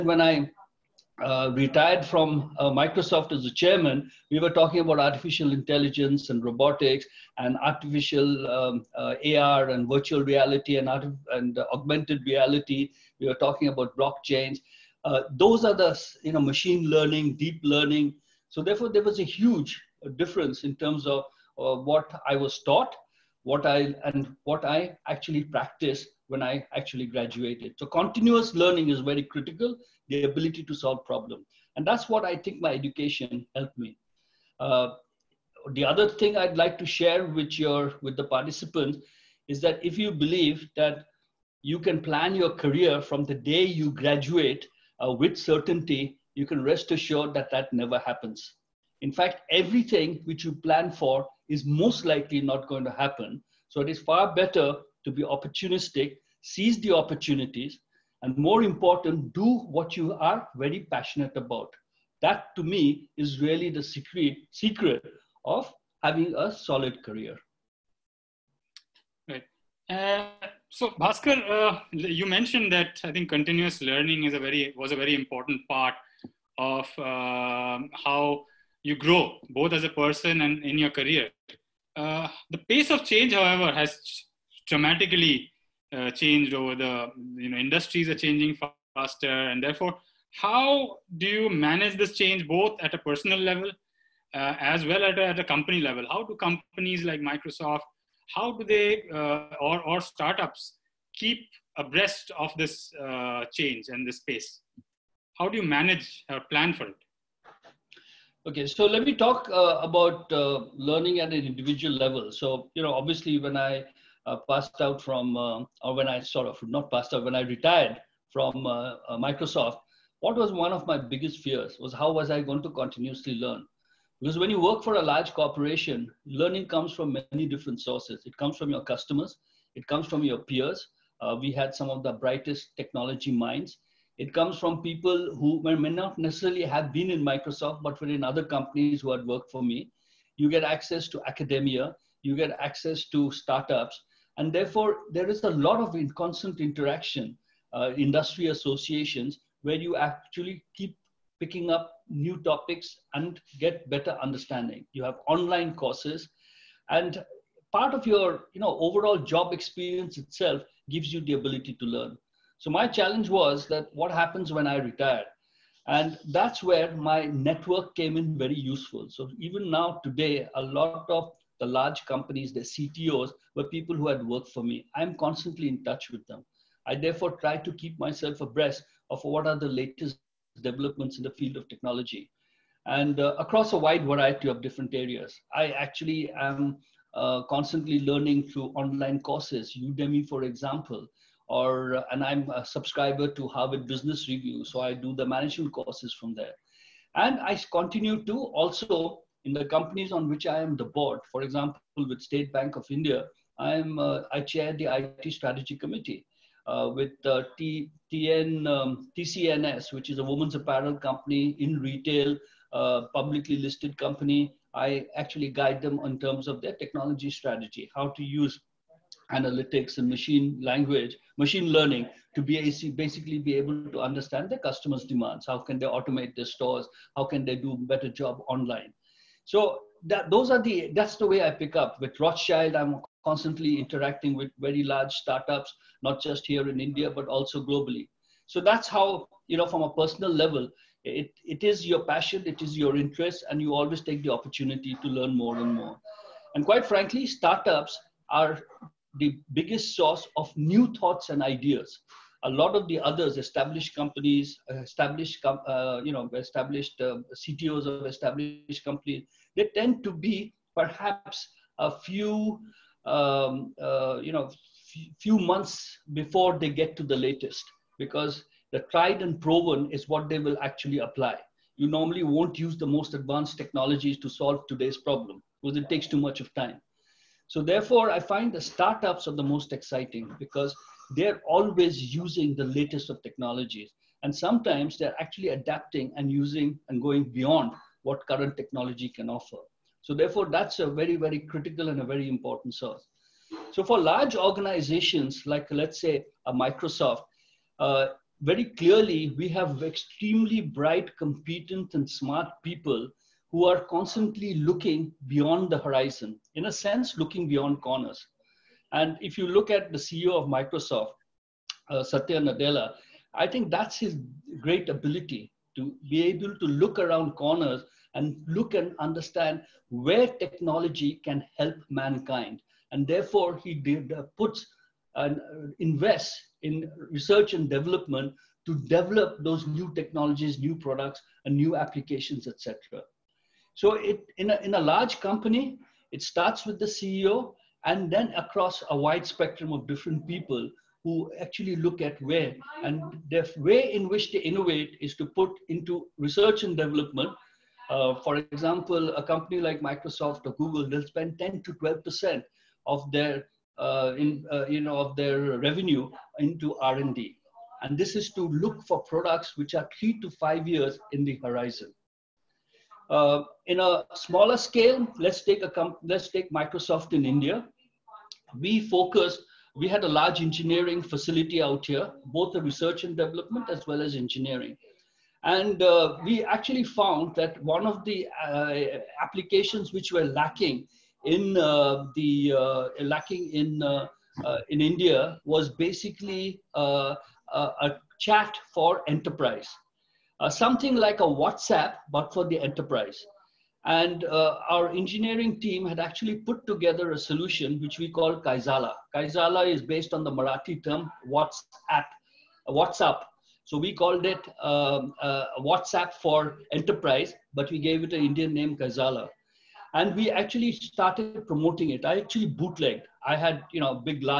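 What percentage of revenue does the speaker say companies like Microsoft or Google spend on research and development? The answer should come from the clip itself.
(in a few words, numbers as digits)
10 to 12%.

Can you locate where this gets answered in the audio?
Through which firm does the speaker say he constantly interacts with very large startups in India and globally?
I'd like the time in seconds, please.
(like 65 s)
232 s.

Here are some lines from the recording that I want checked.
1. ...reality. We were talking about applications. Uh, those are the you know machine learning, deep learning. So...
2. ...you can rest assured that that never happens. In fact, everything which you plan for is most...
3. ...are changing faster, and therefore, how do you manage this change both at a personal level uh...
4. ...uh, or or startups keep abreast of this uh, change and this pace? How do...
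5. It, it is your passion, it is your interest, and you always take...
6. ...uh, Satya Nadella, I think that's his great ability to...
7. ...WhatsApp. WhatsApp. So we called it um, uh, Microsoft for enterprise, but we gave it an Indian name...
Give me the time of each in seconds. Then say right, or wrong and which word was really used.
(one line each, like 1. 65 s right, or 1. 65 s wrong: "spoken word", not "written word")
1. 12 s wrong: "blockchains", not "applications"
2. 46 s right
3. 88 s right
4. 99 s right
5. 241 s right
6. 311 s right
7. 401 s wrong: "WhatsApp", not "Microsoft".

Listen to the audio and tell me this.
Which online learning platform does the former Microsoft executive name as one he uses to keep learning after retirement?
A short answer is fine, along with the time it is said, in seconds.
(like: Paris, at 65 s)
Udemy, at 189 s.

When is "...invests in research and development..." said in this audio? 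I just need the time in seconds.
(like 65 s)
325 s.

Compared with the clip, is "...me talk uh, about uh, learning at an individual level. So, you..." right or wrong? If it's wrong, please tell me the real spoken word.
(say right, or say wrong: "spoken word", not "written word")
right.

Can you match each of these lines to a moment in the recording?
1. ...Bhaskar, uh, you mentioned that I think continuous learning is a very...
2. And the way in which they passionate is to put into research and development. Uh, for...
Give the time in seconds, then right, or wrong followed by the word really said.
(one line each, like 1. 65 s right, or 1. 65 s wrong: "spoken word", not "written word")
1. 70 s right
2. 342 s wrong: "innovate", not "passionate".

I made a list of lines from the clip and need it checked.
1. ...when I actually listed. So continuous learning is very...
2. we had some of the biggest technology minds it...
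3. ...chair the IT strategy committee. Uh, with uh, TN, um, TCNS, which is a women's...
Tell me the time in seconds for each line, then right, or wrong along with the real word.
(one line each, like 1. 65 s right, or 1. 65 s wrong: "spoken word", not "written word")
1. 26 s wrong: "graduated", not "listed"
2. 131 s wrong: "brightest", not "biggest"
3. 204 s right.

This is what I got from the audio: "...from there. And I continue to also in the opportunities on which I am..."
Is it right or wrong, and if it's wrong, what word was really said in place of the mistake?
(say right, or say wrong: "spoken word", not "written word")
wrong: "companies", not "opportunities".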